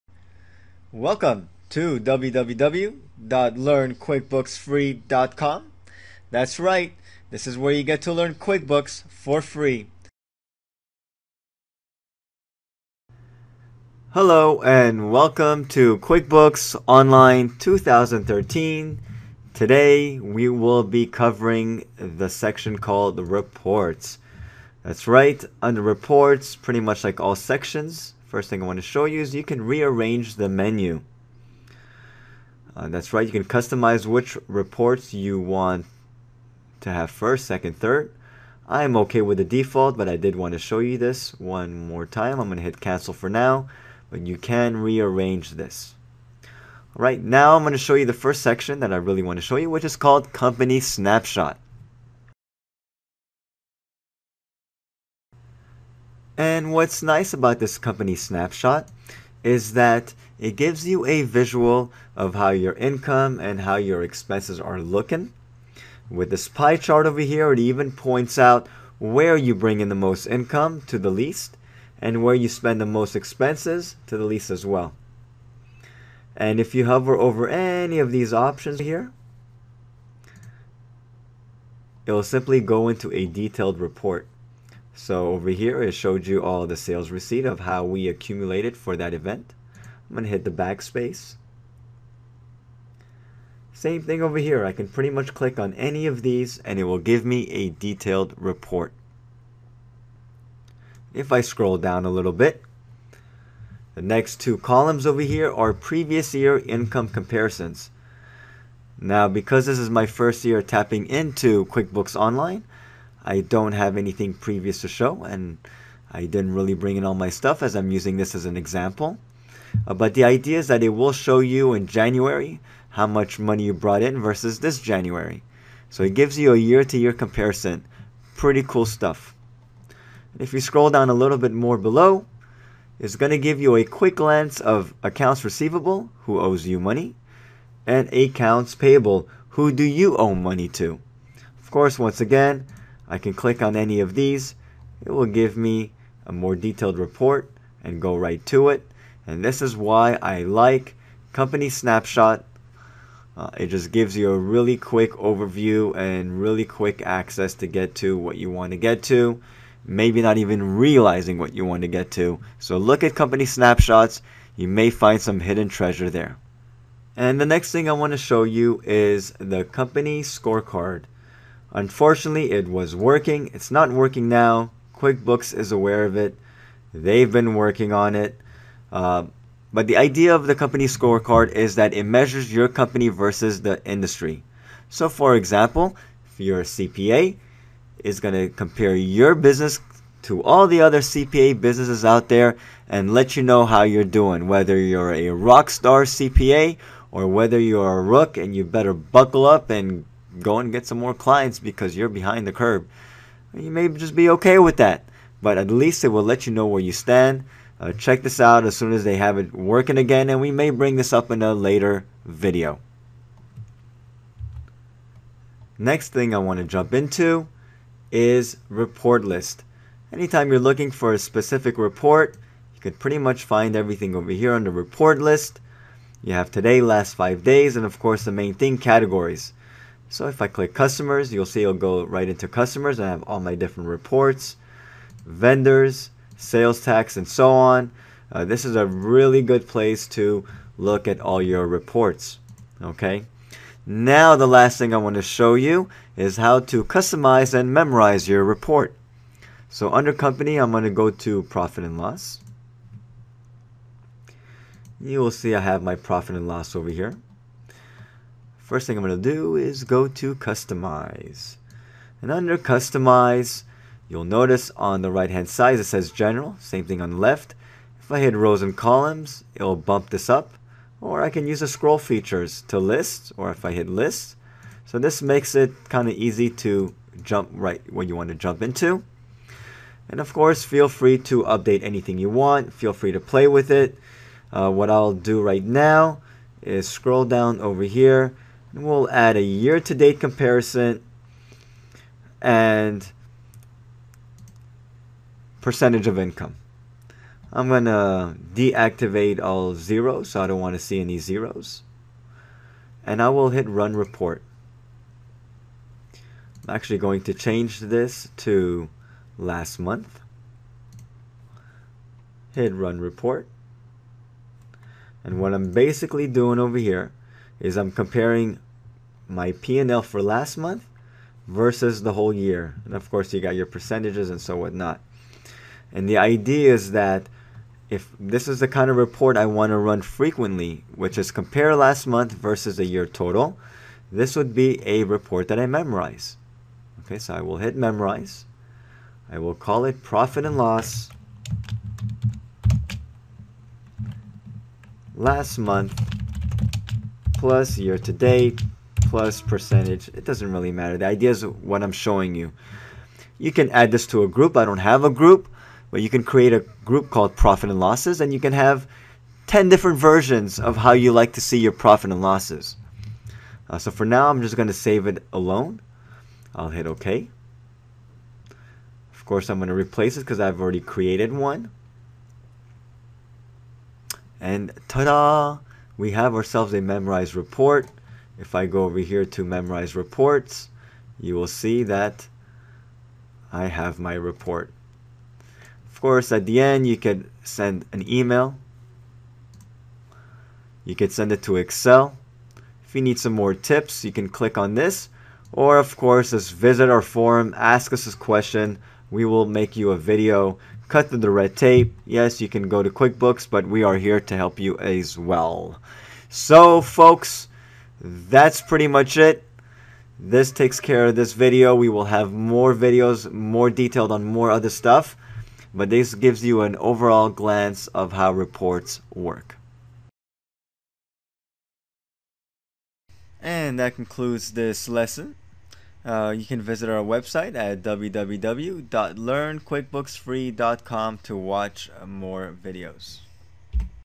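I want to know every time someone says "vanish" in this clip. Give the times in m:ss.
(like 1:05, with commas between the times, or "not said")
not said.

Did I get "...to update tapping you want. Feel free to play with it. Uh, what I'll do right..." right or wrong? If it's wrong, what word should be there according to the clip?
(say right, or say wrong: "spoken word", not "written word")
wrong: "anything", not "tapping".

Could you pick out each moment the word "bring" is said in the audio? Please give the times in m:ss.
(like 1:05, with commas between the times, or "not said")
1:09, 1:56, 3:30.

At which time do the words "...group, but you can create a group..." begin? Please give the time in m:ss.
5:55.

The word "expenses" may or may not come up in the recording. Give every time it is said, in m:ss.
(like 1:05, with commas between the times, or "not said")
1:04, 1:13.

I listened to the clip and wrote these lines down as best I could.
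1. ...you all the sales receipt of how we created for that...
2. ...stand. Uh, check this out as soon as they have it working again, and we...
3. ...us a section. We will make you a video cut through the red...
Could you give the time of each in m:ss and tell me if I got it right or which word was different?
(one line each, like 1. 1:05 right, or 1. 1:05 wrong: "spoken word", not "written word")
1. 1:26 wrong: "accumulated", not "created"
2. 3:26 right
3. 6:37 wrong: "question", not "section".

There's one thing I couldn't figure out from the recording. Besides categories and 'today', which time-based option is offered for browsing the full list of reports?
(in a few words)
Last five days.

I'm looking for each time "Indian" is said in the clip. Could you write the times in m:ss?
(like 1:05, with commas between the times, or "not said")
not said.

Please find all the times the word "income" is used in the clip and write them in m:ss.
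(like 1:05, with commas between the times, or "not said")
1:02, 1:10, 1:46, 4:56.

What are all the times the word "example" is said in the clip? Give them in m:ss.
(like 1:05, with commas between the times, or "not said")
1:58, 3:05.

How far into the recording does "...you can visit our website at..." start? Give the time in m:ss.
7:06.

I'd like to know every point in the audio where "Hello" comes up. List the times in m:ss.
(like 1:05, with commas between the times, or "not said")
0:14.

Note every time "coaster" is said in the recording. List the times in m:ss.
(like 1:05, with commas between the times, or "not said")
not said.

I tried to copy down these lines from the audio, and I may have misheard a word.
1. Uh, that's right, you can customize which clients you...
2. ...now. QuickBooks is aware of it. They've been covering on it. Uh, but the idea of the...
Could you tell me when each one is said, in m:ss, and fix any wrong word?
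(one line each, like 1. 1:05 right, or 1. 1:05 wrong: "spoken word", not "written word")
1. 0:32 wrong: "reports", not "clients"
2. 2:54 wrong: "working", not "covering".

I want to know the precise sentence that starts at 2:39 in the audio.
Maybe not even realizing what you want to get to.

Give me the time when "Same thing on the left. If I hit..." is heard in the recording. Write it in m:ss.
4:26.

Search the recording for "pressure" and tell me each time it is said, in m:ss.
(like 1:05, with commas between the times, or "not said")
not said.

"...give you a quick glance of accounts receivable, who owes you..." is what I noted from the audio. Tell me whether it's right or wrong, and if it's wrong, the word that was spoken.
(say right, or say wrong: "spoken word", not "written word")
right.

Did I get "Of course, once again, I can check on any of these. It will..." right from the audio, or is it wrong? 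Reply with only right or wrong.
wrong.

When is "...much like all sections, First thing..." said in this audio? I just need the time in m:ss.
0:26.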